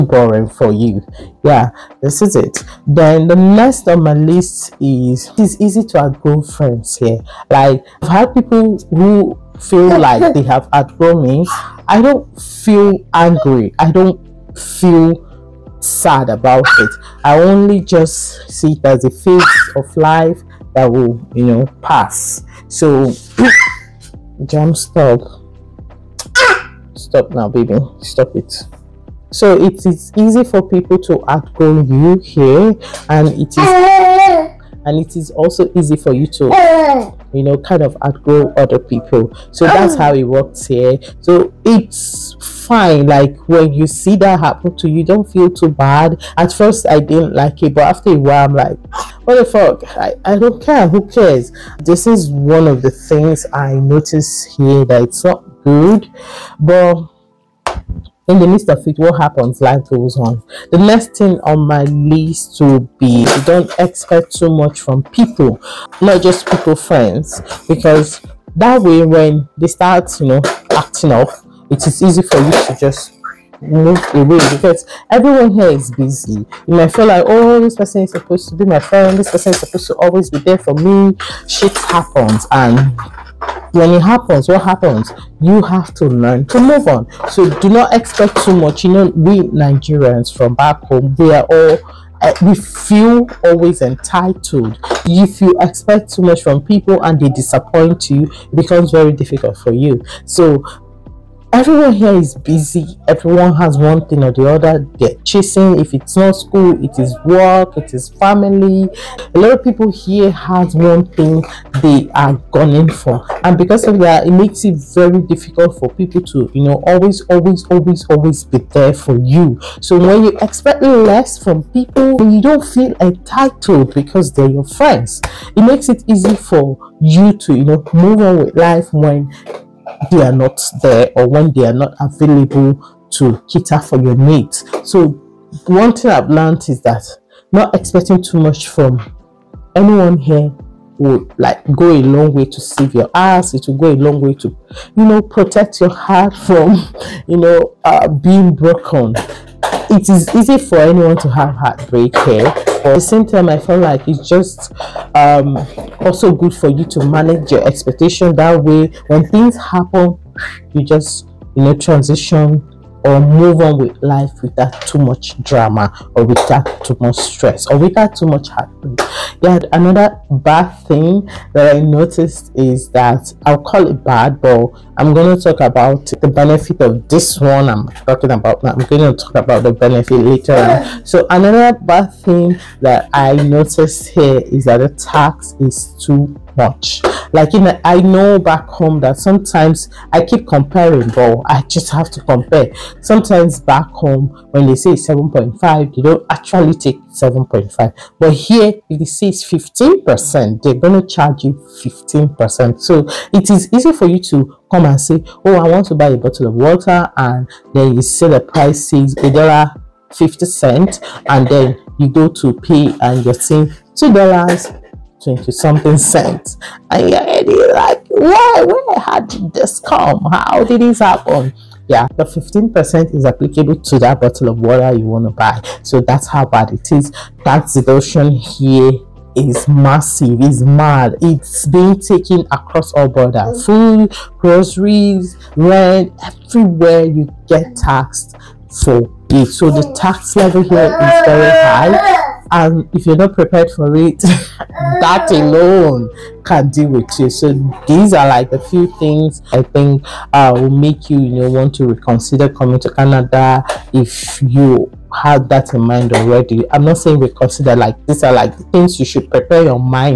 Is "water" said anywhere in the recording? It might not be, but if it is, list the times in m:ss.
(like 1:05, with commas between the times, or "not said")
3:26, 3:44.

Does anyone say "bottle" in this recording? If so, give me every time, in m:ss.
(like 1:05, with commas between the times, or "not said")
3:26, 3:44.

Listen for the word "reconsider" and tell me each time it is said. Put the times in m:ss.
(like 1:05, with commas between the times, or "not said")
4:11, 4:17.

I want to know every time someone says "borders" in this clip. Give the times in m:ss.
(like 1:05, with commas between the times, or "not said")
3:53.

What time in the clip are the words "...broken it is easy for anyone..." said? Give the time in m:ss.
2:28.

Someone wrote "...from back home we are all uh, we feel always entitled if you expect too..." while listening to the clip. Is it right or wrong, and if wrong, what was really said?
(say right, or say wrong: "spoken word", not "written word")
right.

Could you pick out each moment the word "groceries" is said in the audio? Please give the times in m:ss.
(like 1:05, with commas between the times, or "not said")
3:54.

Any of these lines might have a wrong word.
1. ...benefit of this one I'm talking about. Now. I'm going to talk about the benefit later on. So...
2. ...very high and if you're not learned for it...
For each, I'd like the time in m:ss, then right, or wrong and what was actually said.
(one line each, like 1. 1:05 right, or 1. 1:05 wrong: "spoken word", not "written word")
1. 2:56 right
2. 4:01 wrong: "prepared", not "learned".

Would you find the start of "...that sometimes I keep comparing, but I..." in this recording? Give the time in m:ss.
3:09.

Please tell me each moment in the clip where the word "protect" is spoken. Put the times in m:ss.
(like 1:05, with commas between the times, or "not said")
2:25.